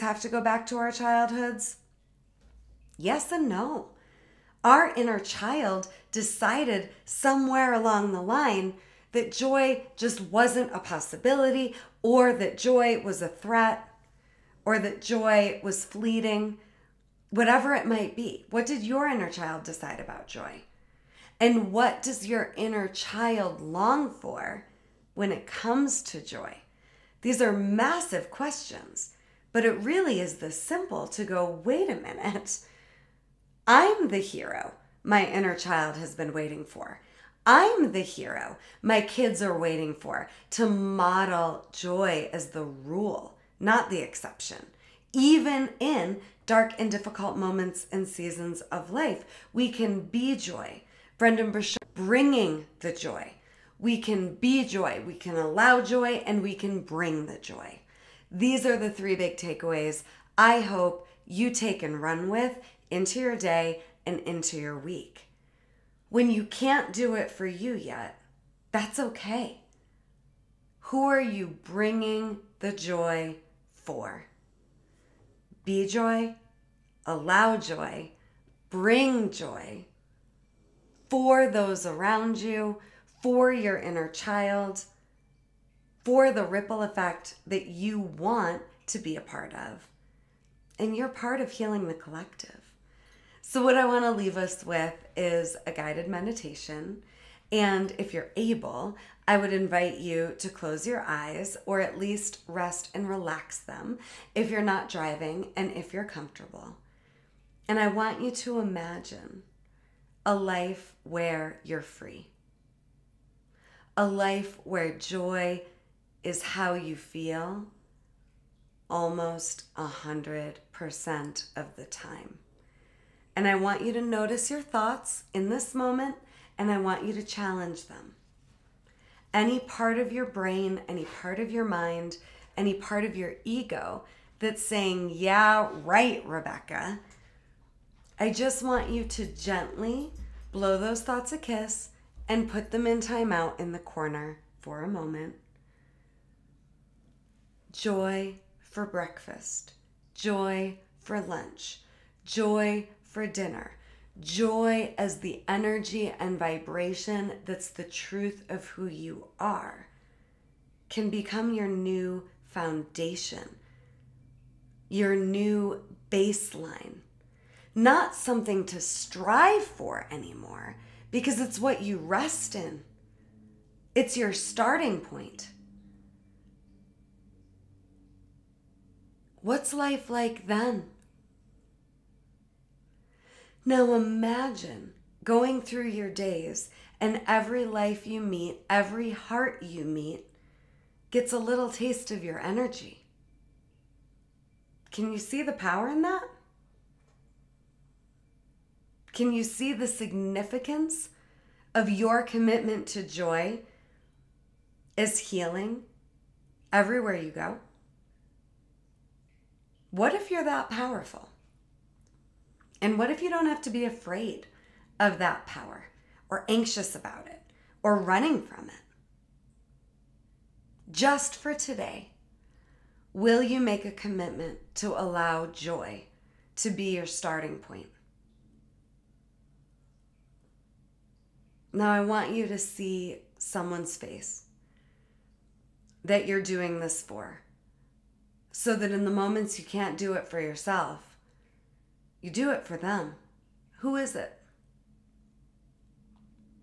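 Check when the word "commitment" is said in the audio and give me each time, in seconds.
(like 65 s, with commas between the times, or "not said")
202 s, 223 s.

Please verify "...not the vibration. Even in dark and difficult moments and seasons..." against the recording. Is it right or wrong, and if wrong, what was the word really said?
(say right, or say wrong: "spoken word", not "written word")
wrong: "exception", not "vibration".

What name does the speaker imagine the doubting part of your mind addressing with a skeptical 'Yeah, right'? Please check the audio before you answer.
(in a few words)
Rebeccah.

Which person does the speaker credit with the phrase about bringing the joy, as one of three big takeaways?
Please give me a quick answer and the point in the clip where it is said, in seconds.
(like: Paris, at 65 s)
Brendan Burchard, at 51 s.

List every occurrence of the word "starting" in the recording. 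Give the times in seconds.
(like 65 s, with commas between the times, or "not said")
174 s, 227 s.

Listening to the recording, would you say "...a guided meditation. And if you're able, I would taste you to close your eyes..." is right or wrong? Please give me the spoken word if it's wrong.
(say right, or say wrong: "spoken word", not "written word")
wrong: "invite", not "taste".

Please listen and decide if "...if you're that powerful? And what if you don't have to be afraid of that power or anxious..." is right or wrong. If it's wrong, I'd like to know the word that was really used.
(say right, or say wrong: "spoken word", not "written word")
right.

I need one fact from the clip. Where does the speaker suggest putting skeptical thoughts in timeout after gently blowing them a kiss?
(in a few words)
in the corner.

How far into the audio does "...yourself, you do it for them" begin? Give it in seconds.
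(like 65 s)
240 s.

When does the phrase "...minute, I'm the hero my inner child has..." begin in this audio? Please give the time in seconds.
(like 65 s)
31 s.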